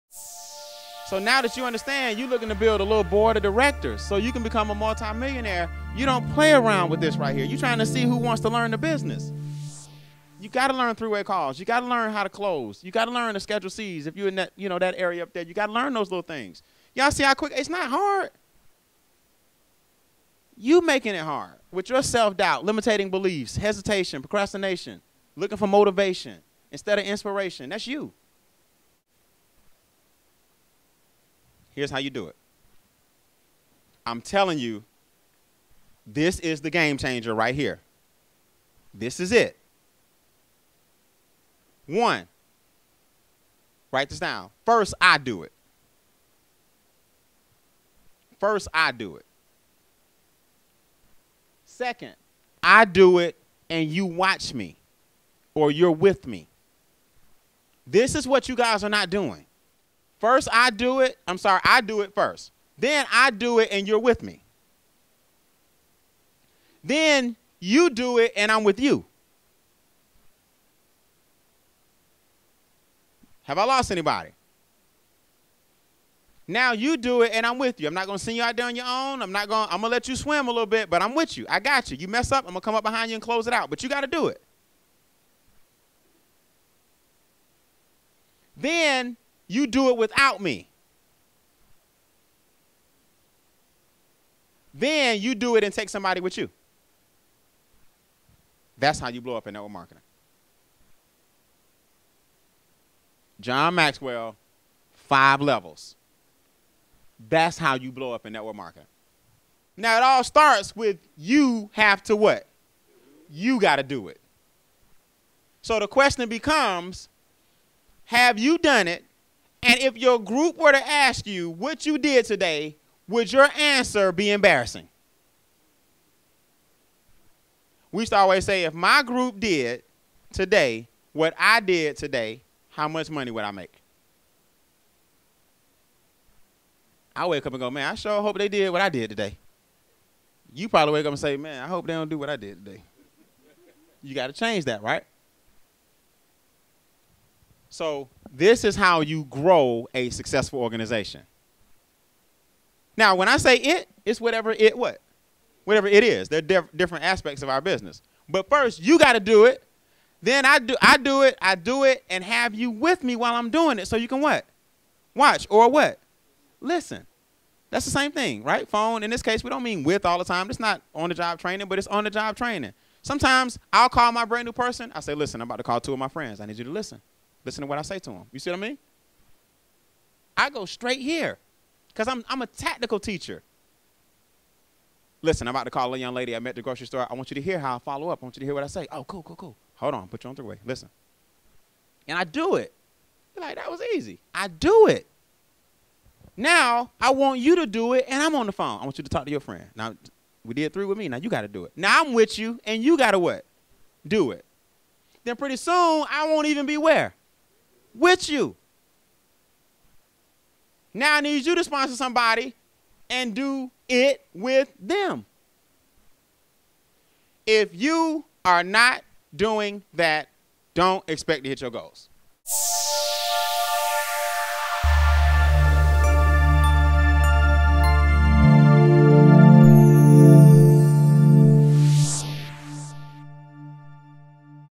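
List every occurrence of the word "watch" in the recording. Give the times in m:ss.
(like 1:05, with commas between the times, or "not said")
0:54, 2:45.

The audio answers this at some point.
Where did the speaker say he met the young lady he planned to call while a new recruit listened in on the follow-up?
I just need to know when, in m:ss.
3:06.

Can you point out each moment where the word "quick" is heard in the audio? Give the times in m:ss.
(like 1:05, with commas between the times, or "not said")
0:17.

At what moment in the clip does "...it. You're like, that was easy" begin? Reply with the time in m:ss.
3:12.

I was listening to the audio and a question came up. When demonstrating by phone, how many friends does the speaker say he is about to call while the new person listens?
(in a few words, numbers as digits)
2.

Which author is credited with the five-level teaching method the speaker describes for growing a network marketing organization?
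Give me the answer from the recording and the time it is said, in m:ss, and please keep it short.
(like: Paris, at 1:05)
John Maxwell, at 1:43.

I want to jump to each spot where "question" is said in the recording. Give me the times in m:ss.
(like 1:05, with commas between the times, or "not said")
1:55.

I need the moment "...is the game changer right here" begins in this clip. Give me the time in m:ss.
0:36.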